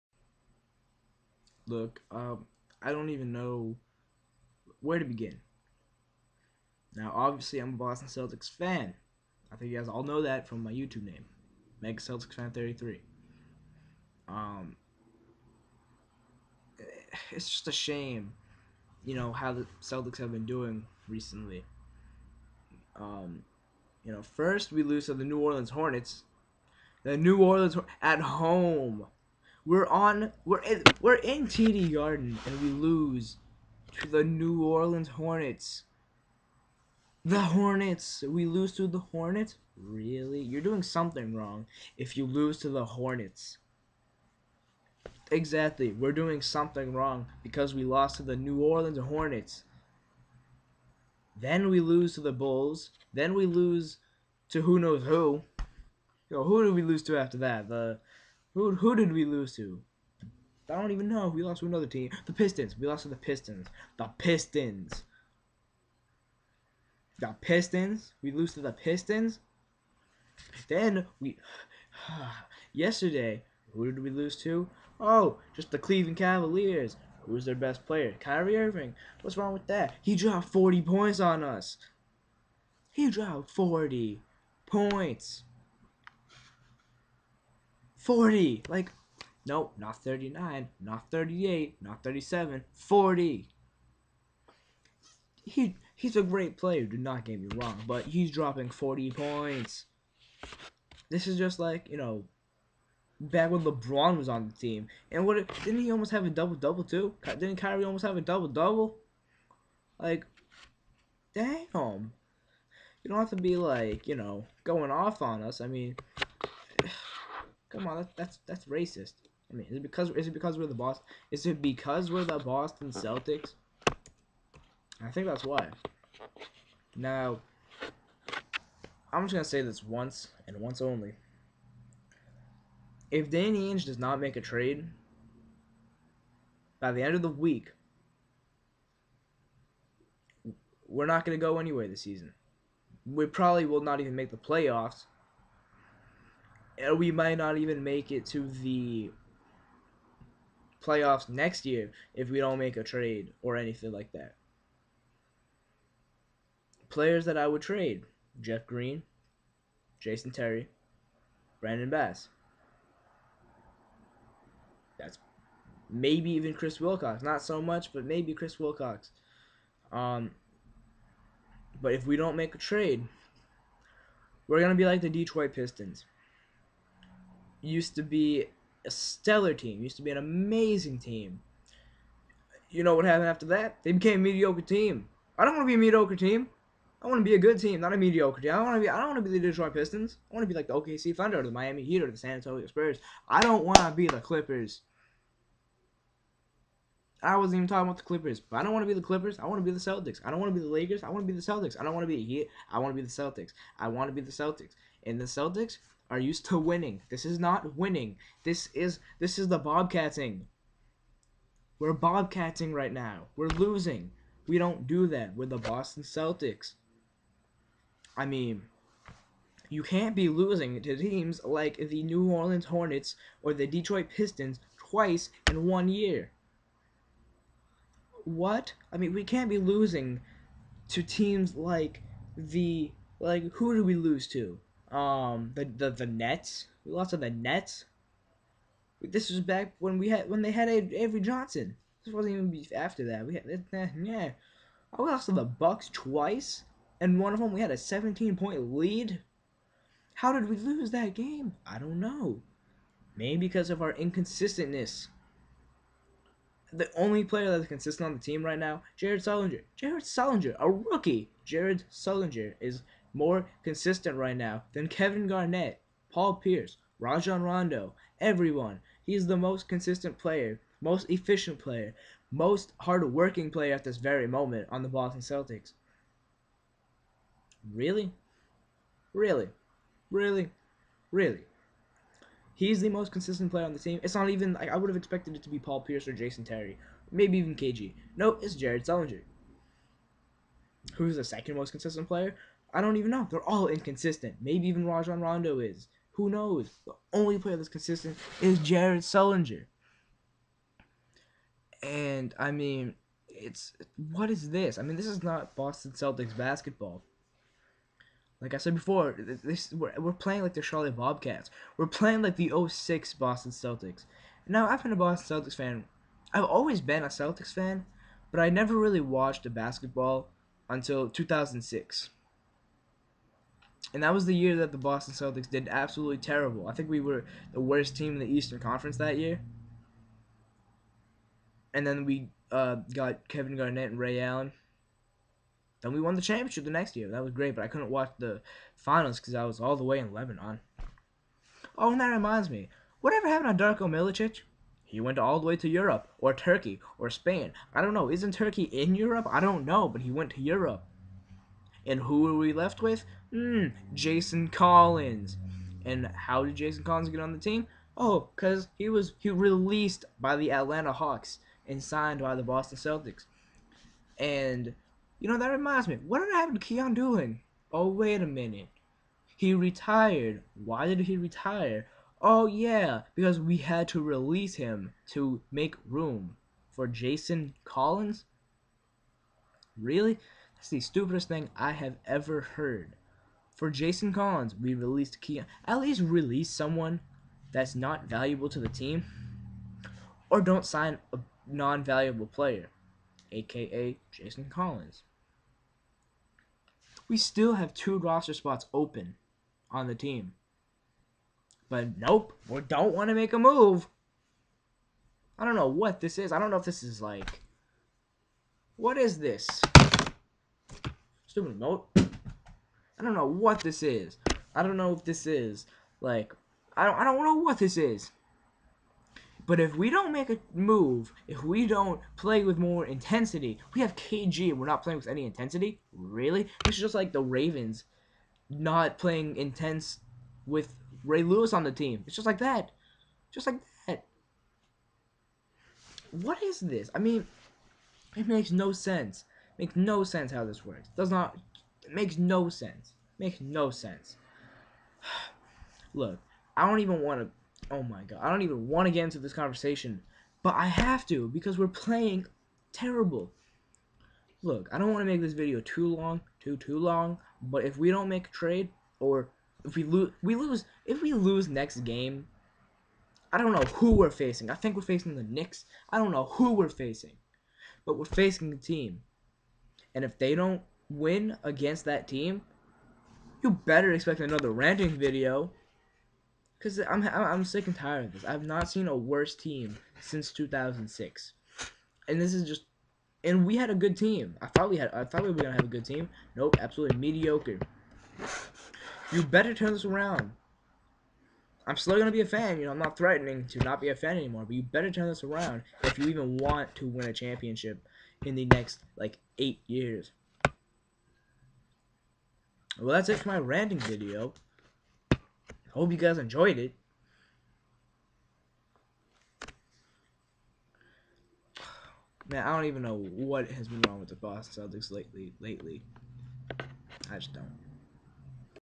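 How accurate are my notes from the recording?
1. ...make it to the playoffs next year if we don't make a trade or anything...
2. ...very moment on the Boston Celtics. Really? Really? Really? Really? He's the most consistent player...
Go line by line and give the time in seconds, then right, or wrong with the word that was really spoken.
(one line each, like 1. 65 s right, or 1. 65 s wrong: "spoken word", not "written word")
1. 147 s right
2. 273 s right.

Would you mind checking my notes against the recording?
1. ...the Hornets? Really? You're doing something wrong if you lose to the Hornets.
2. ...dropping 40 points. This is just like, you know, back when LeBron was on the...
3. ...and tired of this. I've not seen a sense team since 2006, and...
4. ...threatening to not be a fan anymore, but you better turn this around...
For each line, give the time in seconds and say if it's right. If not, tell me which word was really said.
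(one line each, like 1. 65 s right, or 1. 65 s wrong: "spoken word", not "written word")
1. 38 s right
2. 98 s right
3. 477 s wrong: "worse", not "sense"
4. 492 s right.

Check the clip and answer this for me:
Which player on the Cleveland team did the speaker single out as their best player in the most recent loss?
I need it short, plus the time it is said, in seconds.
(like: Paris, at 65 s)
Kyrie Irving, at 78 s.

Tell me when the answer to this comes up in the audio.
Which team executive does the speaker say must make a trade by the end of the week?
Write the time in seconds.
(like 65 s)
133 s.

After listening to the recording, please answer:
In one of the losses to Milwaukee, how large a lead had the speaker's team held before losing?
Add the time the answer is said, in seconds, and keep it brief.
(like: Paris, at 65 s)
17 points, at 247 s.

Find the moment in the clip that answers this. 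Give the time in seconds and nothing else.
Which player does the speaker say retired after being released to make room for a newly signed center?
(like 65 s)
366 s.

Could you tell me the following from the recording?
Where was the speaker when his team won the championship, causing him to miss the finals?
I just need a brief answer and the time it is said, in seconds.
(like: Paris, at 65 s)
Lebanon, at 340 s.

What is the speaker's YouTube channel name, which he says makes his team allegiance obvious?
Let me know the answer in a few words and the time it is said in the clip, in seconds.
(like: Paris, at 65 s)
Mega Celtics Fan 33, at 11 s.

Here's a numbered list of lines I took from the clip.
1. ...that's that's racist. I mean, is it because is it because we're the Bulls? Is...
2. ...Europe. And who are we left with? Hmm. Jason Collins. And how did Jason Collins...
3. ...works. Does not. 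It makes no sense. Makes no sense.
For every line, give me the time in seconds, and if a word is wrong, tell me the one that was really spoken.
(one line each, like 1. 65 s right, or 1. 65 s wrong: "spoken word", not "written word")
1. 118 s wrong: "Boston", not "Bulls"
2. 350 s right
3. 440 s right.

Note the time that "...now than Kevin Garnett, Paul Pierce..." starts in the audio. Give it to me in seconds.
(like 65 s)
264 s.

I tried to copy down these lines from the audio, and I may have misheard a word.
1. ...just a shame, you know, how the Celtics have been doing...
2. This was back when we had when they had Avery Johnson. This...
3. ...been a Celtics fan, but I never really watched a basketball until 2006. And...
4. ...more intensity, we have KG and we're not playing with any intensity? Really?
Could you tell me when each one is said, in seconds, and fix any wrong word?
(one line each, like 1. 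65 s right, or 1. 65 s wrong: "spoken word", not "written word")
1. 17 s right
2. 239 s right
3. 316 s right
4. 422 s right.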